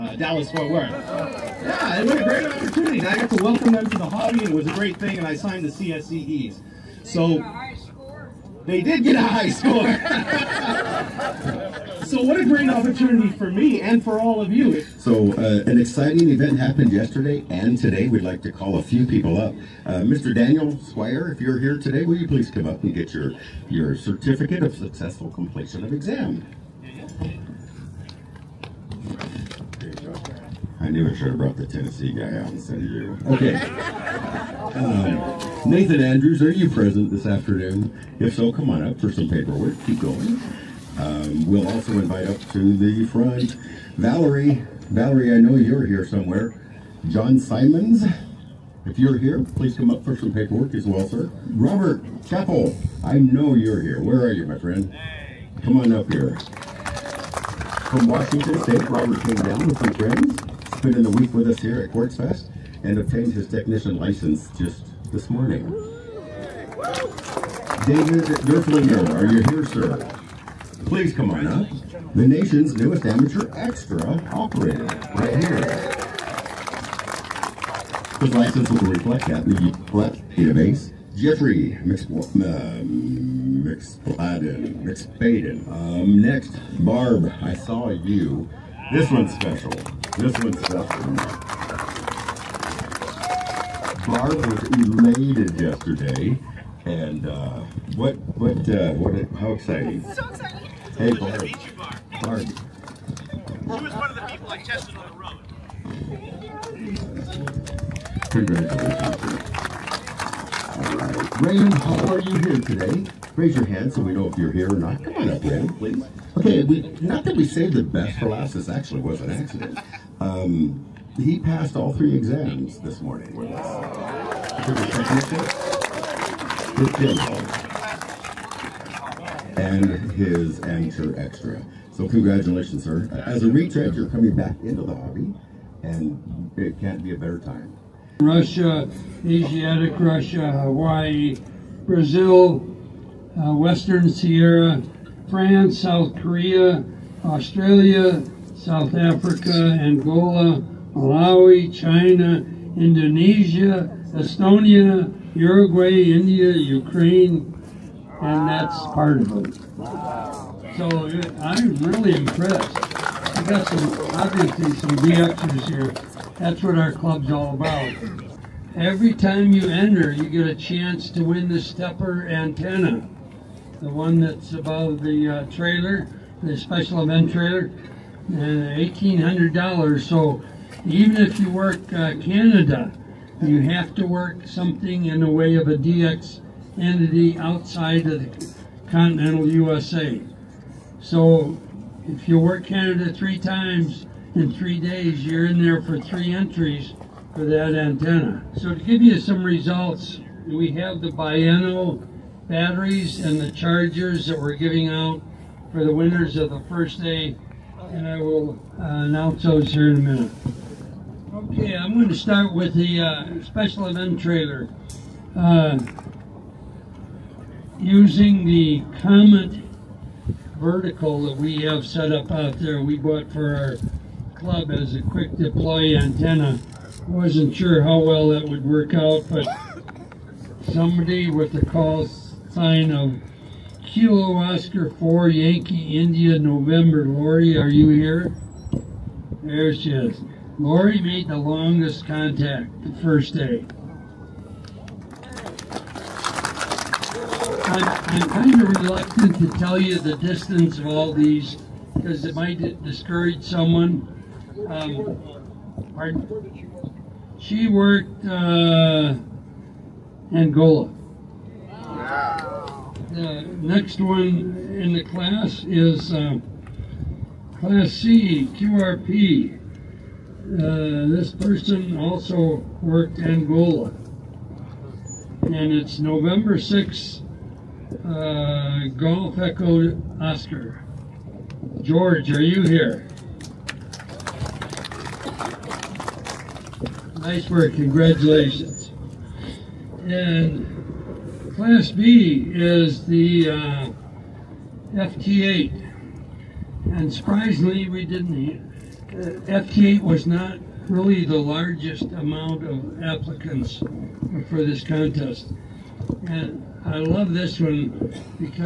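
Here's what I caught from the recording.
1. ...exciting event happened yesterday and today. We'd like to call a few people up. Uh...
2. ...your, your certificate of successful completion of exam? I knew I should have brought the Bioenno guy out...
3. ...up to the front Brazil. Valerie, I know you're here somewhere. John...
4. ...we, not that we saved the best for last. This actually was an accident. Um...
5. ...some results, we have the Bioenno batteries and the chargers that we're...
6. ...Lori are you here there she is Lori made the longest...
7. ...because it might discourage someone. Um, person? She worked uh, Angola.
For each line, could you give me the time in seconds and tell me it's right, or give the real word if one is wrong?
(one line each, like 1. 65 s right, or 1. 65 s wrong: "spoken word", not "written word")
1. 15 s right
2. 23 s wrong: "Tennessee", not "Bioenno"
3. 42 s wrong: "Valerie", not "Brazil"
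4. 116 s right
5. 199 s right
6. 237 s right
7. 251 s wrong: "pardon", not "person".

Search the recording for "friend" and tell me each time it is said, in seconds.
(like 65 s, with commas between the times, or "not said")
54 s, 59 s.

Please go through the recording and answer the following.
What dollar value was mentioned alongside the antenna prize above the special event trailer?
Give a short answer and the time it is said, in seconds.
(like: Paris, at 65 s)
$1,800, at 178 s.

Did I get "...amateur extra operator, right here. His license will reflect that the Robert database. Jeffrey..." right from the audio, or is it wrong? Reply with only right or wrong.
wrong.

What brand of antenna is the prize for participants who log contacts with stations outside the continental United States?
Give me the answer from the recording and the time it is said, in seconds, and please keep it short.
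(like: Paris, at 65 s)
SteppIR, at 171 s.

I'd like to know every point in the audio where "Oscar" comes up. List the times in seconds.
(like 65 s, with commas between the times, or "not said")
234 s, 280 s.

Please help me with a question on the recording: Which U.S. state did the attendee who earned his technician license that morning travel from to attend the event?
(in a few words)
Washington State.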